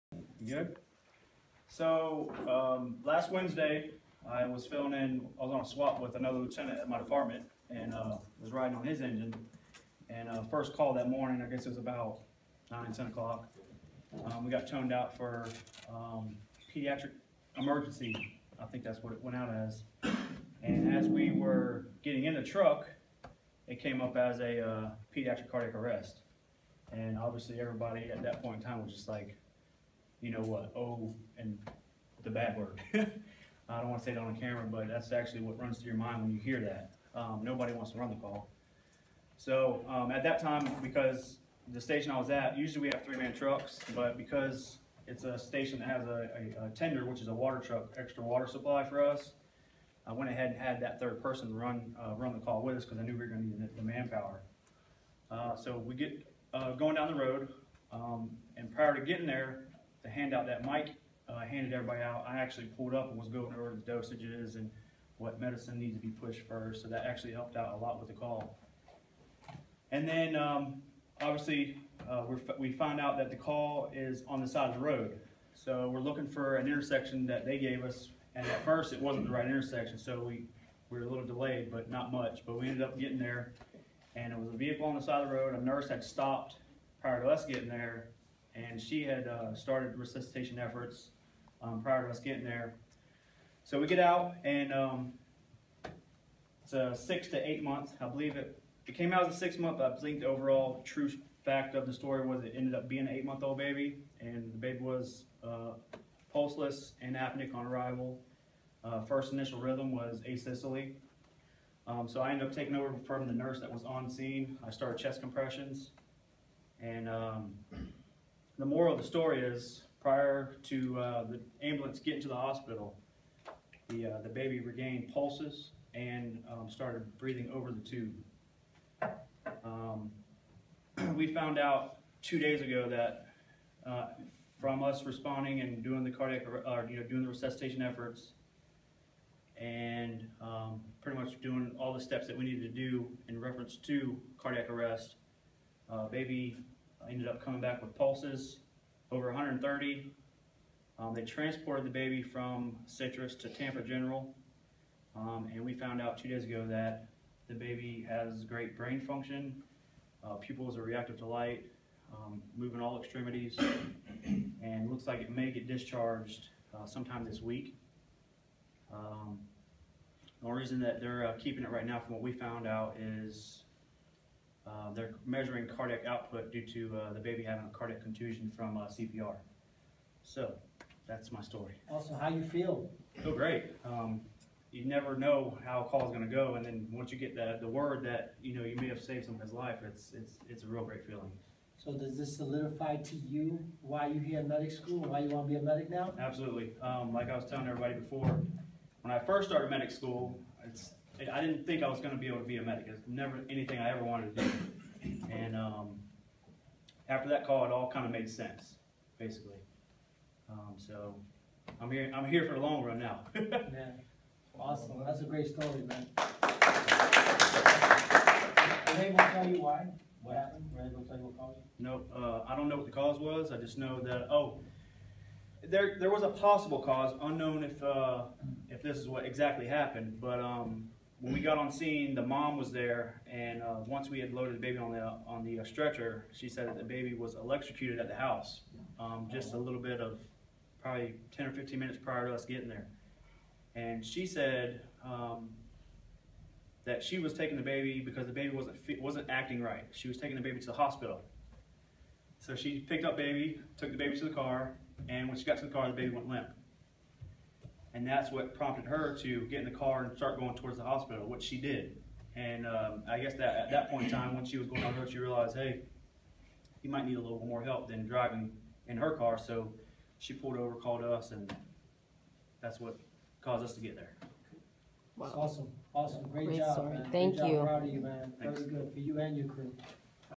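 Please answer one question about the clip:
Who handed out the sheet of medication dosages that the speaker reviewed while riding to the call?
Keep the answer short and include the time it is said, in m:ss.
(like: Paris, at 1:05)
Mike, at 1:00.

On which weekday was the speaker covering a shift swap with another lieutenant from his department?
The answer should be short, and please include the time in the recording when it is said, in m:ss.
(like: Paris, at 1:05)
Wednesday, at 0:03.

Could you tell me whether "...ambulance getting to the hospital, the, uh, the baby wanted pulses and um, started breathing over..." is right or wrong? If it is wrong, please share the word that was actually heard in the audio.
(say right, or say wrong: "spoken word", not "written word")
wrong: "regained", not "wanted".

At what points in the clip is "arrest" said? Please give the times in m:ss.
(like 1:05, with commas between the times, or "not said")
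0:25, 2:24.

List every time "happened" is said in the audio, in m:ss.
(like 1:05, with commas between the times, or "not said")
3:40, 3:49.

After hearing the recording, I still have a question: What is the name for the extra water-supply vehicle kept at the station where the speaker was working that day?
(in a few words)
Tender.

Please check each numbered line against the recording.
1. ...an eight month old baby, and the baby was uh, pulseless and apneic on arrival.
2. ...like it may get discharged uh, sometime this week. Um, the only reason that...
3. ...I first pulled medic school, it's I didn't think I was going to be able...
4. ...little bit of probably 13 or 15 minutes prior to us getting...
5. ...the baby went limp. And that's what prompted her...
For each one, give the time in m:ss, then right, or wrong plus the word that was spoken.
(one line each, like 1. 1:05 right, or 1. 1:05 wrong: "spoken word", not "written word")
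1. 1:43 right
2. 2:45 right
3. 3:19 wrong: "started", not "pulled"
4. 3:59 wrong: "10", not "13"
5. 4:15 right.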